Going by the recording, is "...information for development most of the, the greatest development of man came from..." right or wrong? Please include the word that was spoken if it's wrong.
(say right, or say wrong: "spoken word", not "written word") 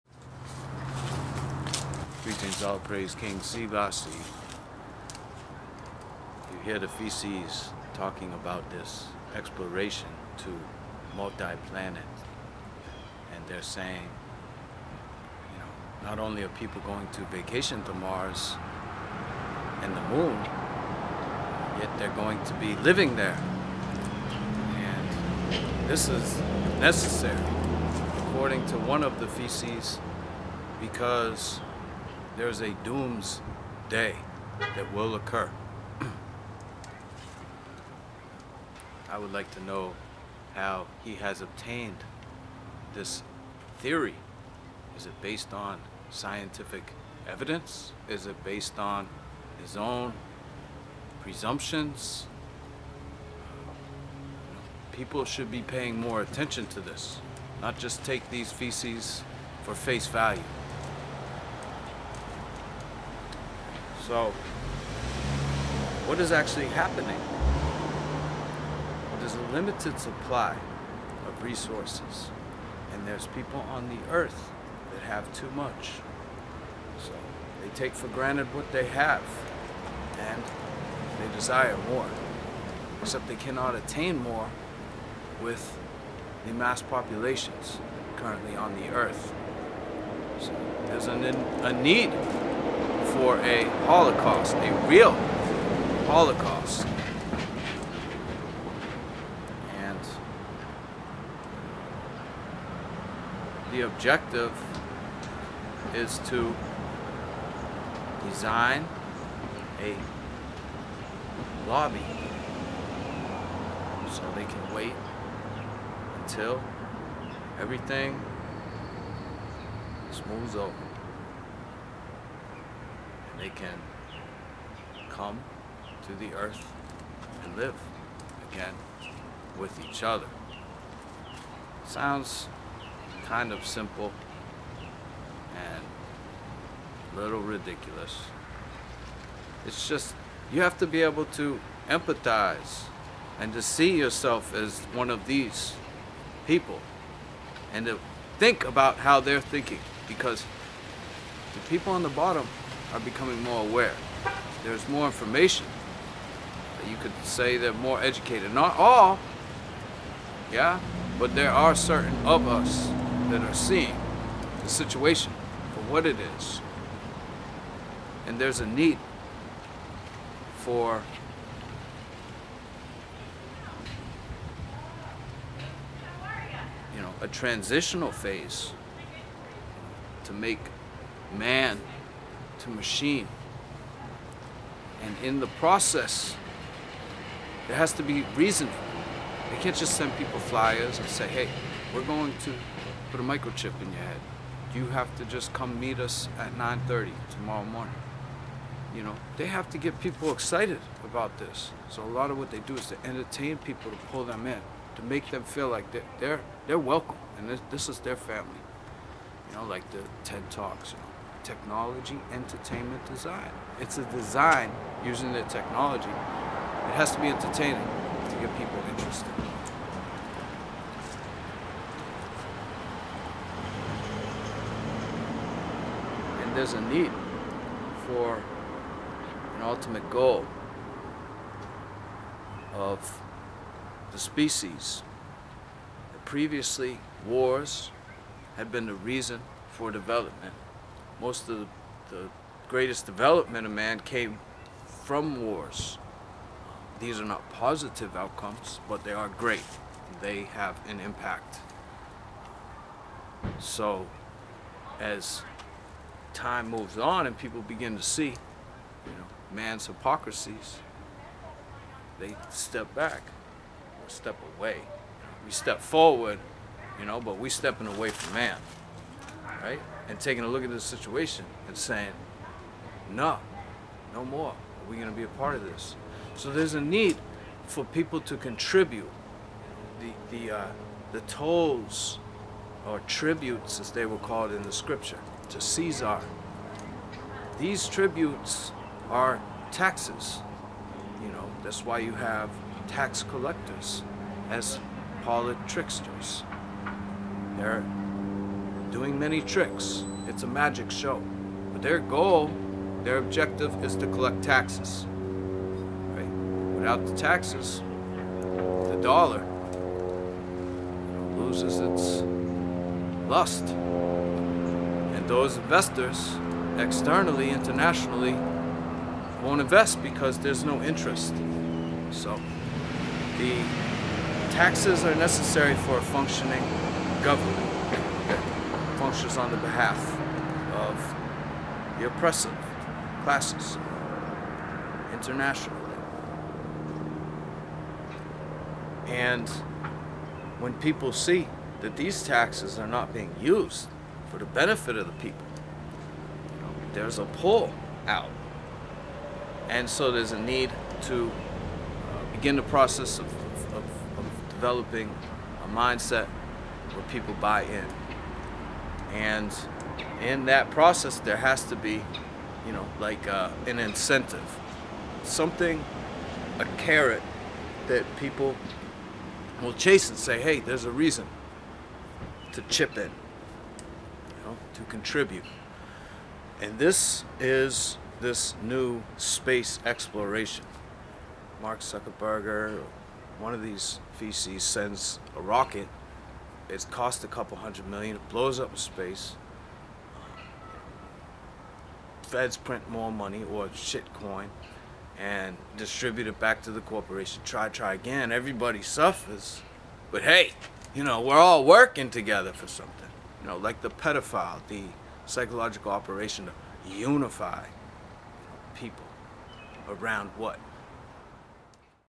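wrong: "reason", not "information".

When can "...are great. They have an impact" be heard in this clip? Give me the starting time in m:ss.
4:09.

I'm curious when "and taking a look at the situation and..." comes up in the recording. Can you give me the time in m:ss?
4:30.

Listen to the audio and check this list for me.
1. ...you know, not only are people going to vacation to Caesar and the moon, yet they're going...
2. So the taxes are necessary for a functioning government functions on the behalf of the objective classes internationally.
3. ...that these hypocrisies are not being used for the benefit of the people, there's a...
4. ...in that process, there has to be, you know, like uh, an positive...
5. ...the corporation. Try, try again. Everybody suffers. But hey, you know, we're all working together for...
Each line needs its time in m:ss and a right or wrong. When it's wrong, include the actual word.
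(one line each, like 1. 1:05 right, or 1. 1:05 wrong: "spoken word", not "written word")
1. 0:15 wrong: "Mars", not "Caesar"
2. 5:22 wrong: "oppressive", not "objective"
3. 5:41 wrong: "taxes", not "hypocrisies"
4. 6:00 wrong: "incentive", not "positive"
5. 6:36 right.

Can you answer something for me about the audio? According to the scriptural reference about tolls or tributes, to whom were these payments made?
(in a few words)
Caesar.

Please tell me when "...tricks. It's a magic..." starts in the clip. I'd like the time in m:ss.
4:59.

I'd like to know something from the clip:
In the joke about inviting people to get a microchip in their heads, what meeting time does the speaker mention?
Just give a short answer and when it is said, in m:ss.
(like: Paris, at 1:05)
9:30, at 3:16.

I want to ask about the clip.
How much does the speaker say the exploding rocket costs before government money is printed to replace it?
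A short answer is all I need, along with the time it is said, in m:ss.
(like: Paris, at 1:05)
a couple hundred million, at 6:27.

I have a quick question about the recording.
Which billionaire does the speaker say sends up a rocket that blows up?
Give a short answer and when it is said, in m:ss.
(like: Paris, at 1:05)
Mark Zuckerberg, at 6:21.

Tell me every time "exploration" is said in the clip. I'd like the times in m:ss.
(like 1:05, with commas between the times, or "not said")
0:09, 6:19.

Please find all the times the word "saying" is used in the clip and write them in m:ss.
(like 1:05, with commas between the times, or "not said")
0:13, 4:31.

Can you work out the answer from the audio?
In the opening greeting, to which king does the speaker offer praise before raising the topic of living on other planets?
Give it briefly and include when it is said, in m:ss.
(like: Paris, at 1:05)
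King Sivasi, at 0:03.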